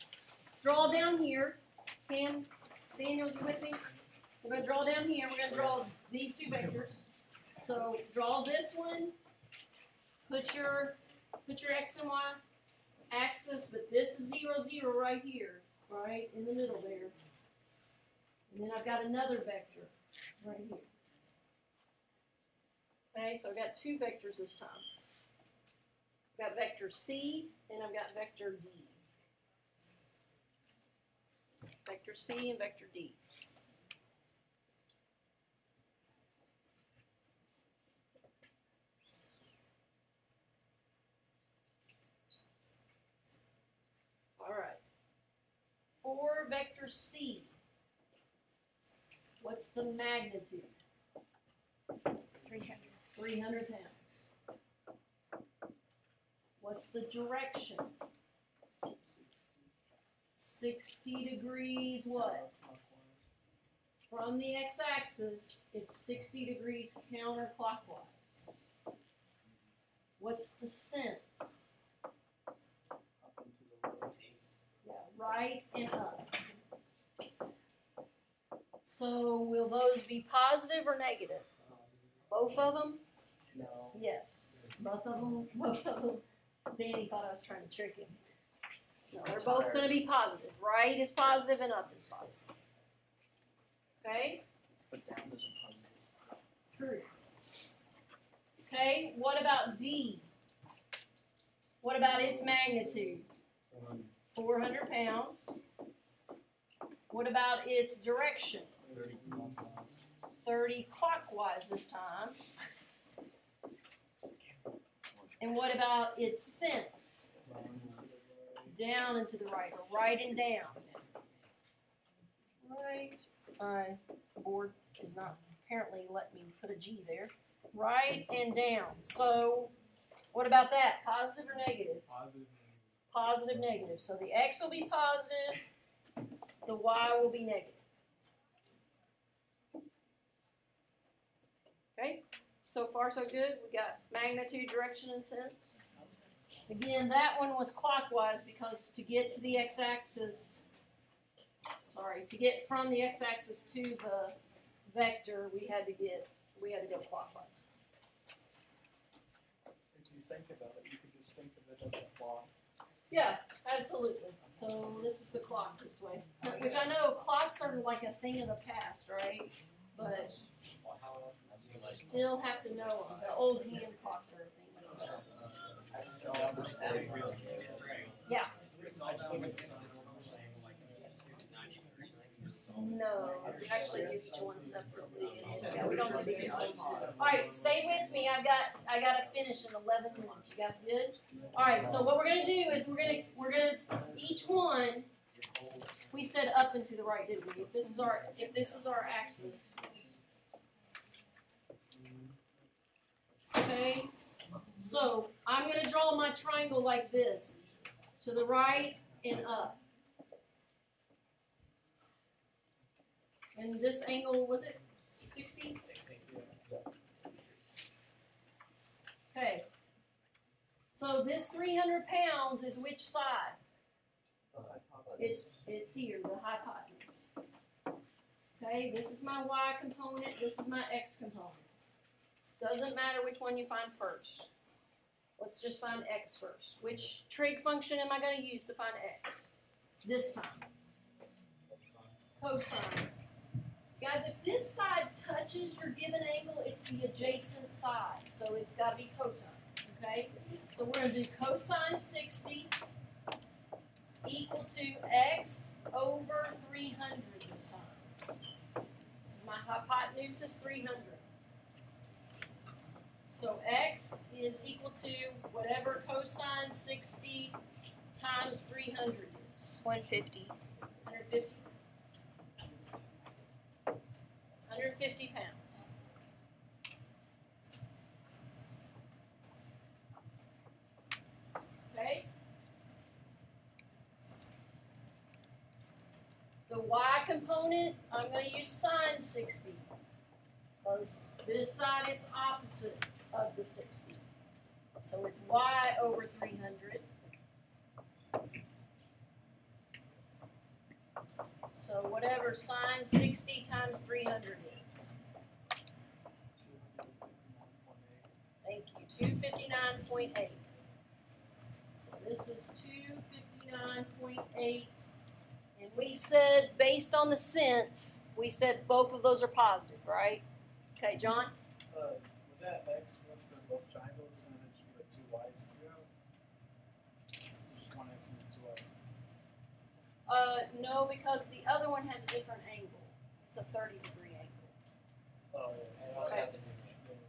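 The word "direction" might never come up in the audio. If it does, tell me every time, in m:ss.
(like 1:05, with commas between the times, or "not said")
0:57, 1:48, 2:24.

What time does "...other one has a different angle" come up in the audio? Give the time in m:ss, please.
5:31.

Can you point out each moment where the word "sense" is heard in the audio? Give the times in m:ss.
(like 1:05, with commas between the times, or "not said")
1:10, 1:56, 2:25, 5:17.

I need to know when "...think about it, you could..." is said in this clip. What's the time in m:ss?
2:40.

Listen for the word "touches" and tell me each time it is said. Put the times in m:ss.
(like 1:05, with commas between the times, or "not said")
4:05.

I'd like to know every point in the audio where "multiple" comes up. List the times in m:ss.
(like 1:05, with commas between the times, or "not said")
not said.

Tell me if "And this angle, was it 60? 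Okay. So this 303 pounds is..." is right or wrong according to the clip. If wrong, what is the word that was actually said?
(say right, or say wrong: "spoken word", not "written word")
wrong: "300", not "303".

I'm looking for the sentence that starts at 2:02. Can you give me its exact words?
Right, my board is not apparently let me put a G there.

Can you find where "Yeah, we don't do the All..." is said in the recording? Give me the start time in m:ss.
3:05.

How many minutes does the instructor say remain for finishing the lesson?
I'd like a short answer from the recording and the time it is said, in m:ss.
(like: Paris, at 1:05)
11 minutes, at 3:09.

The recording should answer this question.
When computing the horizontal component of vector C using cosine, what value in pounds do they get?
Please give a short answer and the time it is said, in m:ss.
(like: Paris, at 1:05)
150, at 4:33.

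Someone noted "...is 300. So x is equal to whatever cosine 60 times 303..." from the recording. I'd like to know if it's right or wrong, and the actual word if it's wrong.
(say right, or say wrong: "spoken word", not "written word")
wrong: "300", not "303".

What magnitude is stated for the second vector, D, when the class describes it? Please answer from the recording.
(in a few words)
400 pounds.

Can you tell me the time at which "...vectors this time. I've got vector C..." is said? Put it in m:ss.
0:23.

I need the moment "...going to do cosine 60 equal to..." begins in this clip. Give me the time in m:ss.
4:10.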